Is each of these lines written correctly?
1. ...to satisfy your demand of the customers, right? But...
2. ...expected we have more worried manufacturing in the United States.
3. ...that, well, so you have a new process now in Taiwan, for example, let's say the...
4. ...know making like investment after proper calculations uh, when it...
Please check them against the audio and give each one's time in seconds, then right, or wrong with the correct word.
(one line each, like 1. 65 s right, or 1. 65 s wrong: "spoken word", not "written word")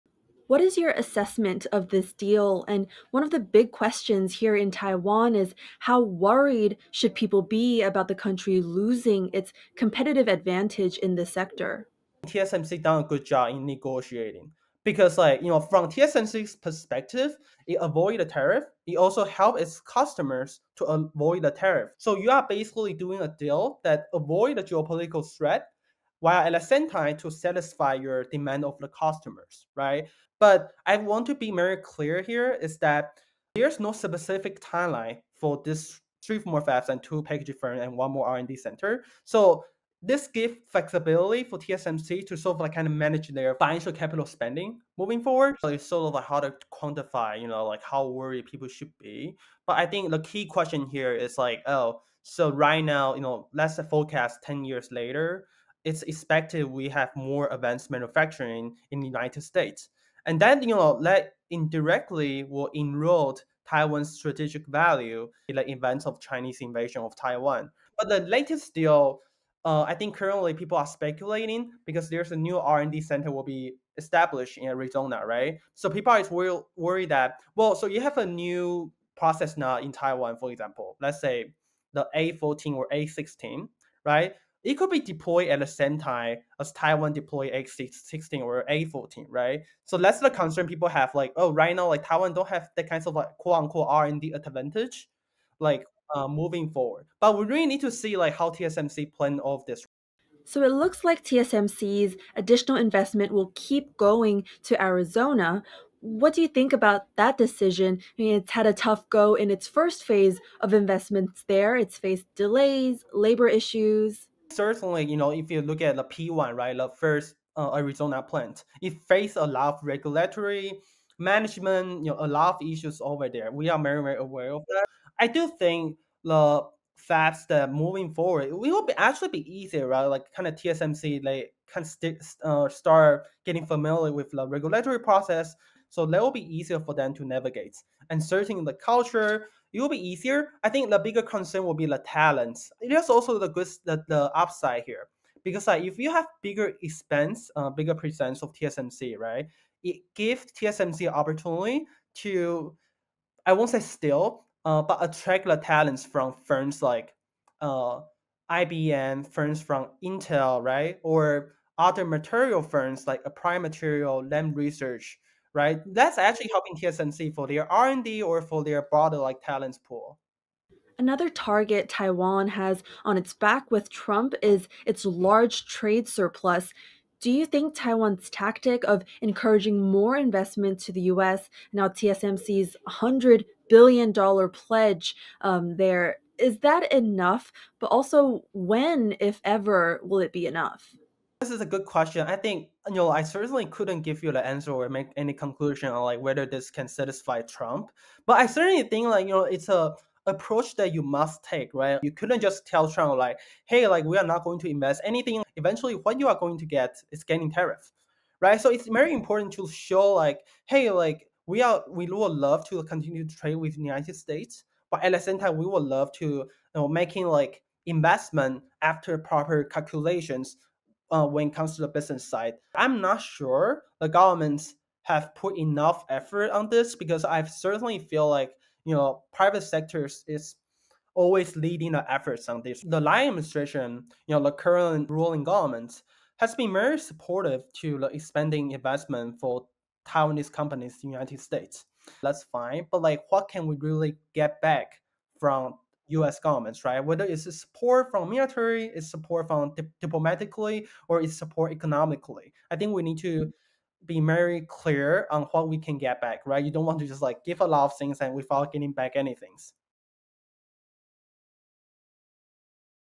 1. 27 s right
2. 56 s wrong: "advanced", not "worried"
3. 77 s right
4. 216 s right.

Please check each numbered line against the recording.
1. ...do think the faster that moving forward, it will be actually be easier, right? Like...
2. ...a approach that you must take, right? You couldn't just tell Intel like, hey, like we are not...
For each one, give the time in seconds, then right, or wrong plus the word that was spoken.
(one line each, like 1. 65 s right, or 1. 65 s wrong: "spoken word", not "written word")
1. 125 s right
2. 199 s wrong: "Trump", not "Intel".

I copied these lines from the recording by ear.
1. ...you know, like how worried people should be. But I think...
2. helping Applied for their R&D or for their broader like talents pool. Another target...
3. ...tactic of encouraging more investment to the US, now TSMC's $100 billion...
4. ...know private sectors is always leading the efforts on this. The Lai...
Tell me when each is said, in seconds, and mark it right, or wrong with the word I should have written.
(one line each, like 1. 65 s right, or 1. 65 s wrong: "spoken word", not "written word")
1. 47 s right
2. 166 s wrong: "TSMC", not "Applied"
3. 178 s right
4. 228 s right.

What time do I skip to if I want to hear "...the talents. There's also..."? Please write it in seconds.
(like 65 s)
141 s.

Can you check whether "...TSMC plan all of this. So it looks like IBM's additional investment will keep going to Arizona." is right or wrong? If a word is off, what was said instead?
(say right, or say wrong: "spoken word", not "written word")
wrong: "TSMC", not "IBM".